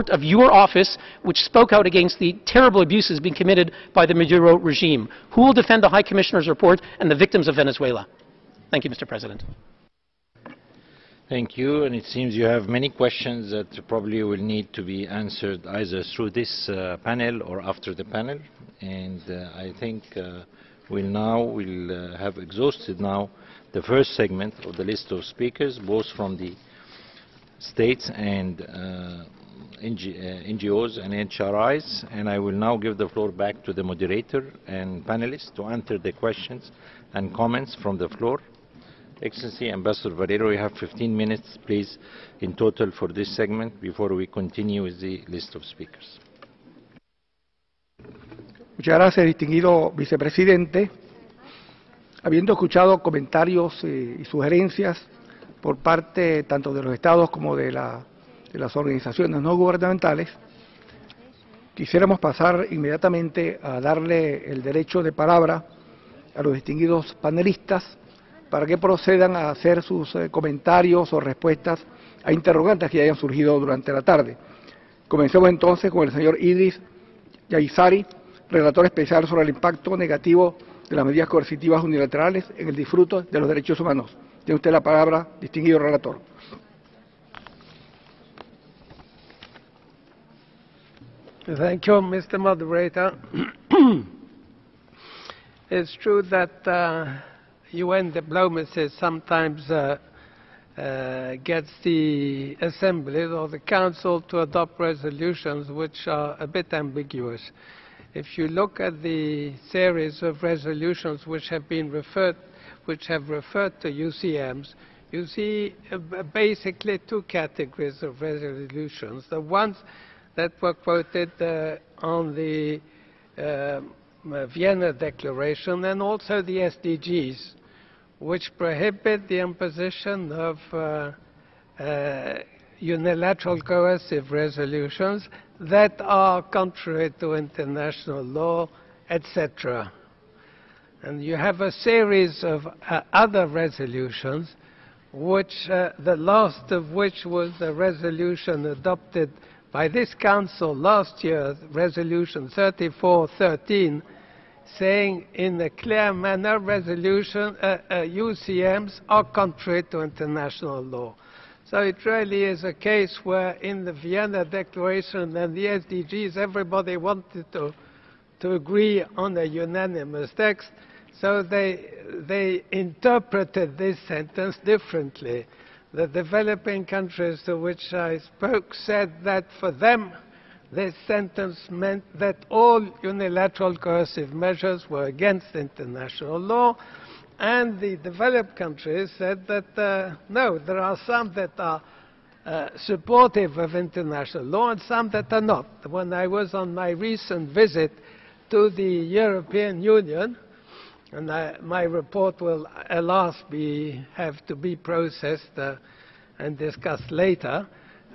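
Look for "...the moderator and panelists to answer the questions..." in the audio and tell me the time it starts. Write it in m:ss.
0:33.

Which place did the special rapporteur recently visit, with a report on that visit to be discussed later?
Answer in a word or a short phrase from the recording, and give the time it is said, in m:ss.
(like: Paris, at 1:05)
European Union, at 3:18.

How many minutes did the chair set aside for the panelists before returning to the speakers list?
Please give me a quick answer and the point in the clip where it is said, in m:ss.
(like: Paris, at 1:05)
15, at 0:40.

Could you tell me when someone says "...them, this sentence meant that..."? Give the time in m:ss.
2:59.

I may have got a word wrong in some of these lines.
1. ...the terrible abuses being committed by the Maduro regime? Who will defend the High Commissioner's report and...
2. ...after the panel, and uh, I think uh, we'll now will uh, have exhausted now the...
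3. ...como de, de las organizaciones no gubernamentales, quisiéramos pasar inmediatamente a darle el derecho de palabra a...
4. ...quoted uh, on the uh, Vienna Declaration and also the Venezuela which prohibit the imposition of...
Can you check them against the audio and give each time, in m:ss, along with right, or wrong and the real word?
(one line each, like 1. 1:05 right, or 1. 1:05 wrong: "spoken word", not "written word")
1. 0:02 right
2. 0:17 right
3. 0:57 right
4. 2:00 wrong: "SDGs", not "Venezuela".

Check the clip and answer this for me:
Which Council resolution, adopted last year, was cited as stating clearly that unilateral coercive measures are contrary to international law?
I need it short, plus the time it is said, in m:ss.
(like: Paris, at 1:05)
Resolution 3413, at 2:32.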